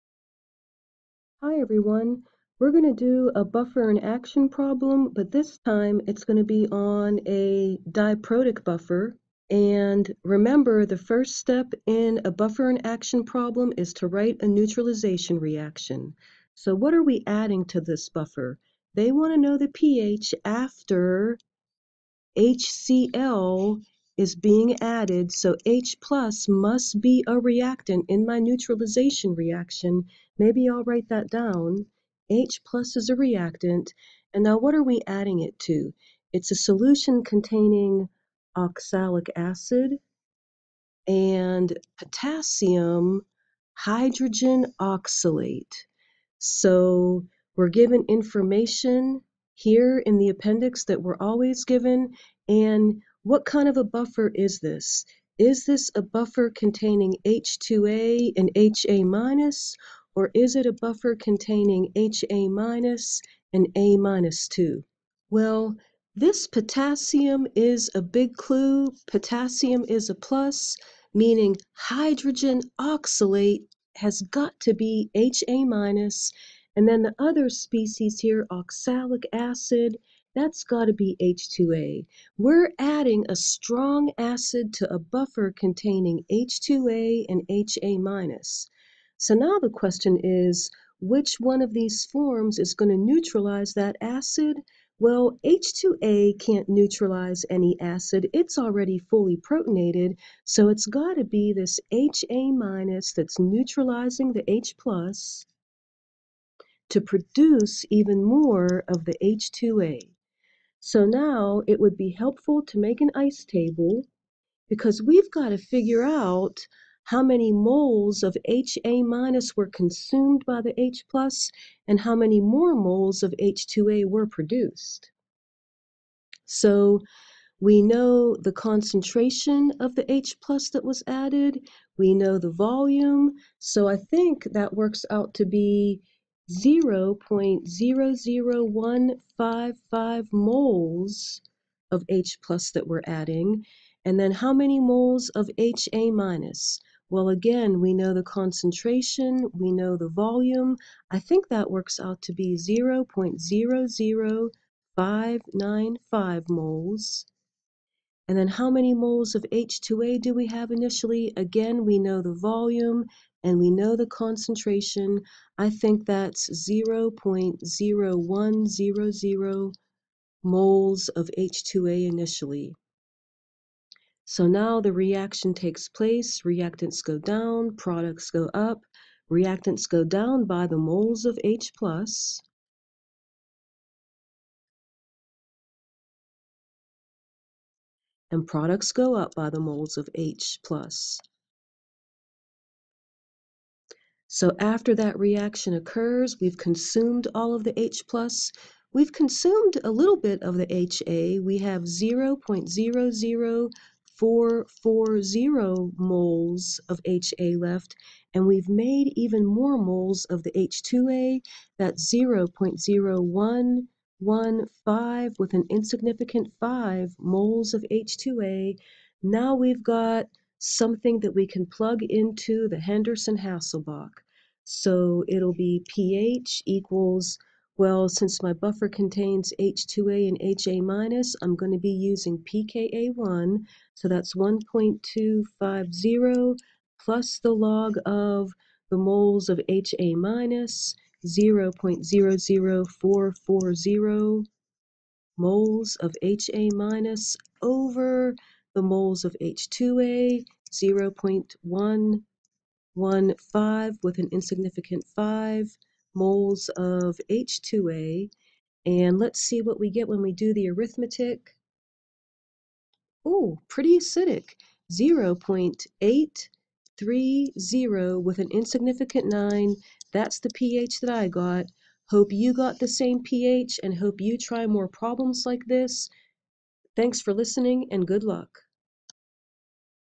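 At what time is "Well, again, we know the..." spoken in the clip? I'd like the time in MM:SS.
02:27.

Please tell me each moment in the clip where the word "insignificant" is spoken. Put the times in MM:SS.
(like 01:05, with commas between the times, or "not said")
03:35, 04:14, 04:28.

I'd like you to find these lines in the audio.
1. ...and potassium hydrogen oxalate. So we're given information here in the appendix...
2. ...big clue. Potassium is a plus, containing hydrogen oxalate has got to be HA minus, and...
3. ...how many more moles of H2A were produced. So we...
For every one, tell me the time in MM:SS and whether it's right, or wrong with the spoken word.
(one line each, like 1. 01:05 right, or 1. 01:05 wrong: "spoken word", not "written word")
1. 00:41 right
2. 01:08 wrong: "meaning", not "containing"
3. 02:01 right.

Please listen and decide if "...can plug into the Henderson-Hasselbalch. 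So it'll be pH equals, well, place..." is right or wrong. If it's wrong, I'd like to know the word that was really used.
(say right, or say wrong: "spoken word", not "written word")
wrong: "since", not "place".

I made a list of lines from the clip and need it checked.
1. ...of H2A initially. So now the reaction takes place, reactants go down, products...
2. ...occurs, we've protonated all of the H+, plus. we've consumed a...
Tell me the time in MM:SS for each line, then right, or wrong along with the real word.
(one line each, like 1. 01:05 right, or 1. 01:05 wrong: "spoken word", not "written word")
1. 02:51 right
2. 03:15 wrong: "consumed", not "protonated".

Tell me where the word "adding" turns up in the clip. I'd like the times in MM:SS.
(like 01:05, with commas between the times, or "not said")
00:17, 00:35, 01:22, 02:23.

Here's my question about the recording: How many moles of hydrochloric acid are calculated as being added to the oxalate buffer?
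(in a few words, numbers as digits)
0.00155 moles.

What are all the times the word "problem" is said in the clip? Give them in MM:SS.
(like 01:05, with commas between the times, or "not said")
00:04, 00:13, 04:34.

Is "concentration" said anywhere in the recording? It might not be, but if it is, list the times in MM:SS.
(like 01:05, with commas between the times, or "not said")
02:08, 02:28, 02:44.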